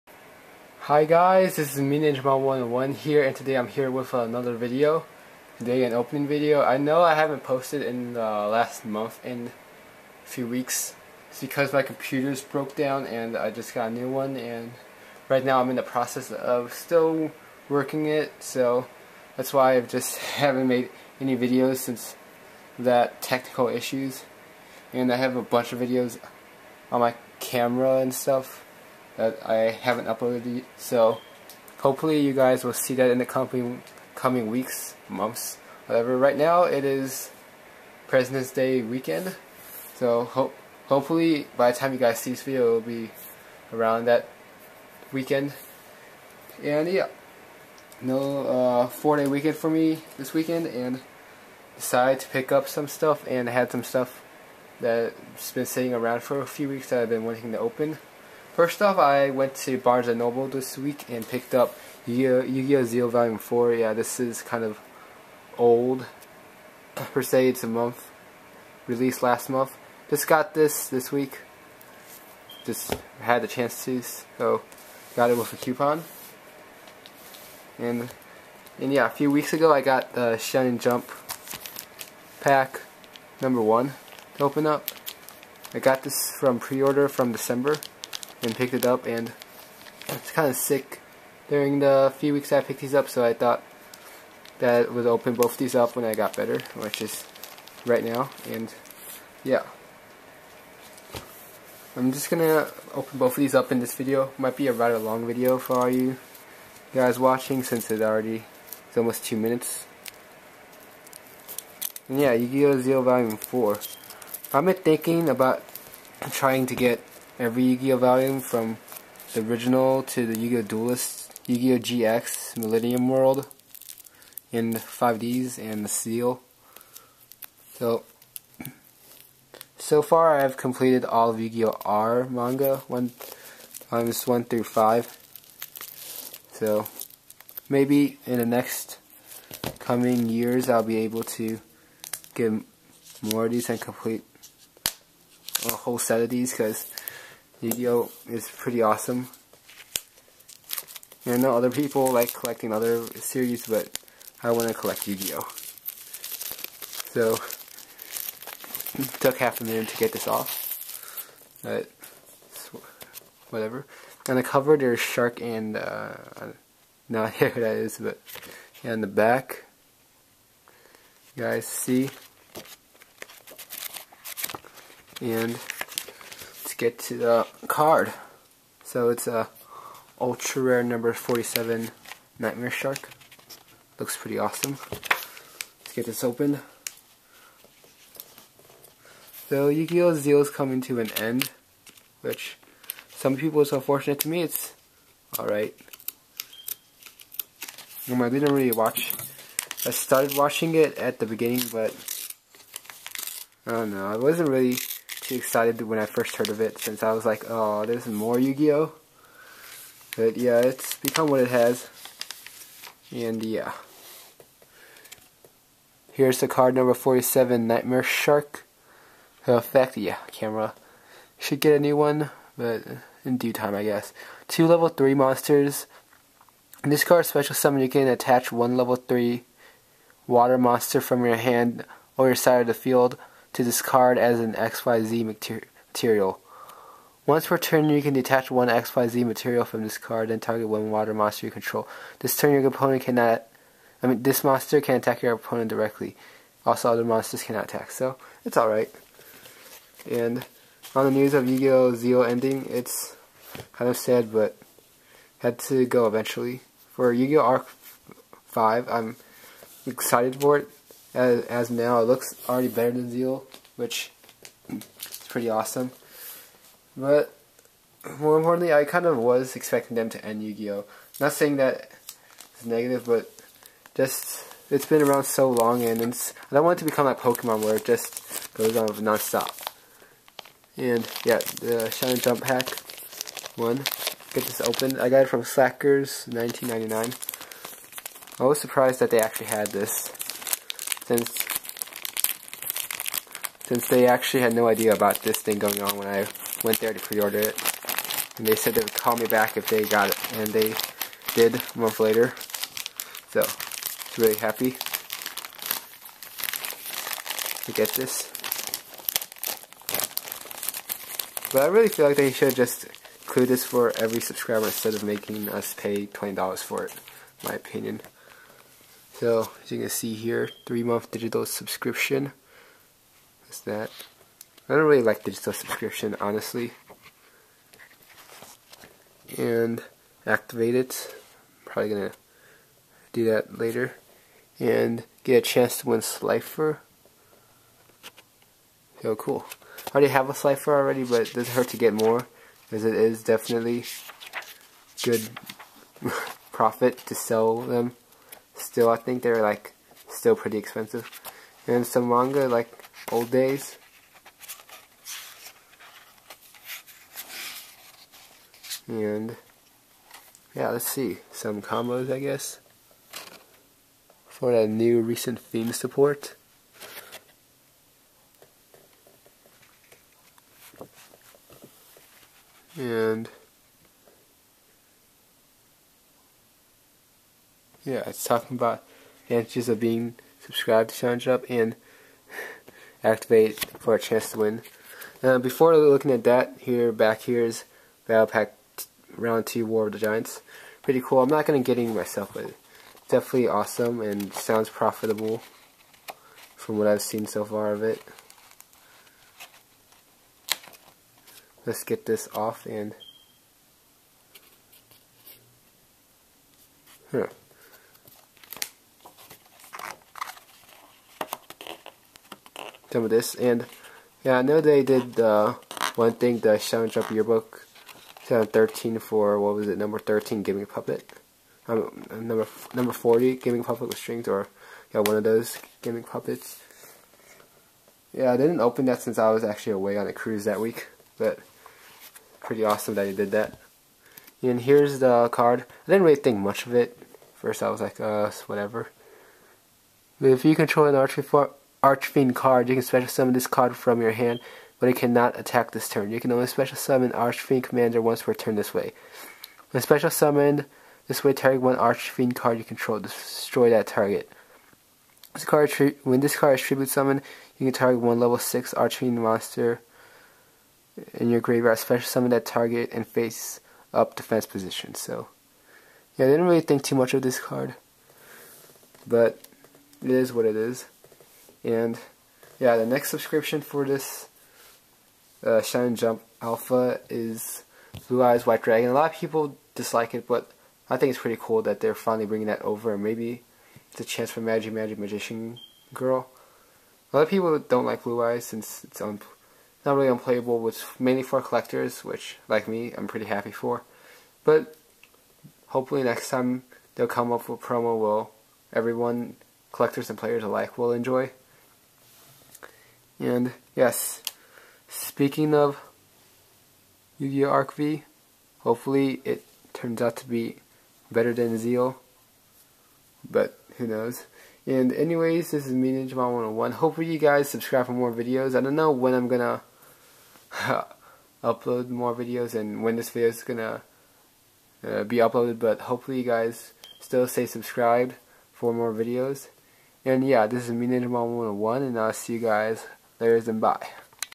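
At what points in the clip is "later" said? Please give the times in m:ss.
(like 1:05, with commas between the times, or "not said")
5:01, 5:33.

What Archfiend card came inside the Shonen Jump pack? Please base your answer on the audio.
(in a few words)
Archfiend Commander.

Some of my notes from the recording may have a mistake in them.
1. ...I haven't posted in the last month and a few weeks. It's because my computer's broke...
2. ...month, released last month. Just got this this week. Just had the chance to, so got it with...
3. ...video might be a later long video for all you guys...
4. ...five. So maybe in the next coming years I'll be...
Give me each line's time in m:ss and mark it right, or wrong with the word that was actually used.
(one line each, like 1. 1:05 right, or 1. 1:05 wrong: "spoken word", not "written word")
1. 0:07 right
2. 1:07 right
3. 1:43 wrong: "rather", not "later"
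4. 2:14 right.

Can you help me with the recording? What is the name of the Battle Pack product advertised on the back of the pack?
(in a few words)
Round 2 War of the Giants.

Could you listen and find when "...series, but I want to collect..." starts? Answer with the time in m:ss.
2:33.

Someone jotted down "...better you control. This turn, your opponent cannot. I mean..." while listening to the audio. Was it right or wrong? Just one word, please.
wrong.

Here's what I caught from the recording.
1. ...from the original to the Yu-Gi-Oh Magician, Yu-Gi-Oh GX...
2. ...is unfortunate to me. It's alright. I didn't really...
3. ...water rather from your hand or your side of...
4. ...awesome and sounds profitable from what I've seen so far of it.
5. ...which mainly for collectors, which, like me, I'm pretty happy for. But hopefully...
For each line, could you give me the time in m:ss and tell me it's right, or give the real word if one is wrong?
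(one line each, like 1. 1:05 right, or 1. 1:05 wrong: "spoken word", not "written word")
1. 1:58 wrong: "Duelist", not "Magician"
2. 3:13 right
3. 3:50 wrong: "monster", not "rather"
4. 6:33 right
5. 8:10 right.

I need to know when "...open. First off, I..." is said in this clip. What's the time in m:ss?
0:57.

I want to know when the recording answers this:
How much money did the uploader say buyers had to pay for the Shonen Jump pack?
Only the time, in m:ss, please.
5:16.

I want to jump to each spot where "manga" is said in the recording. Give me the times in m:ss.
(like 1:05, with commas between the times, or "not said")
2:12, 5:52.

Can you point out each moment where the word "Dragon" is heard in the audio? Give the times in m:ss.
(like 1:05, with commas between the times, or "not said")
7:58.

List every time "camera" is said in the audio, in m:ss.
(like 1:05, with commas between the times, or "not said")
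0:27, 3:40.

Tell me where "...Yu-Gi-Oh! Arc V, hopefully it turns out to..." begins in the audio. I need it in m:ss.
8:27.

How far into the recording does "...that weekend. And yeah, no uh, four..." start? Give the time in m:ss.
0:44.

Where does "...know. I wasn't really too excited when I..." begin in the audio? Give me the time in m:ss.
3:23.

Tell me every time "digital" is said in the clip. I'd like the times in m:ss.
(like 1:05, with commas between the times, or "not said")
5:21, 5:25.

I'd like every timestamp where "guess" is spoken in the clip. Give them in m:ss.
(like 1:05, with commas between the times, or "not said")
3:43, 6:02.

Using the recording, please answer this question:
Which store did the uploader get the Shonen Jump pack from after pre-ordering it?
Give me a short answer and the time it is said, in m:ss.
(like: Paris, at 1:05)
Slackers, at 4:45.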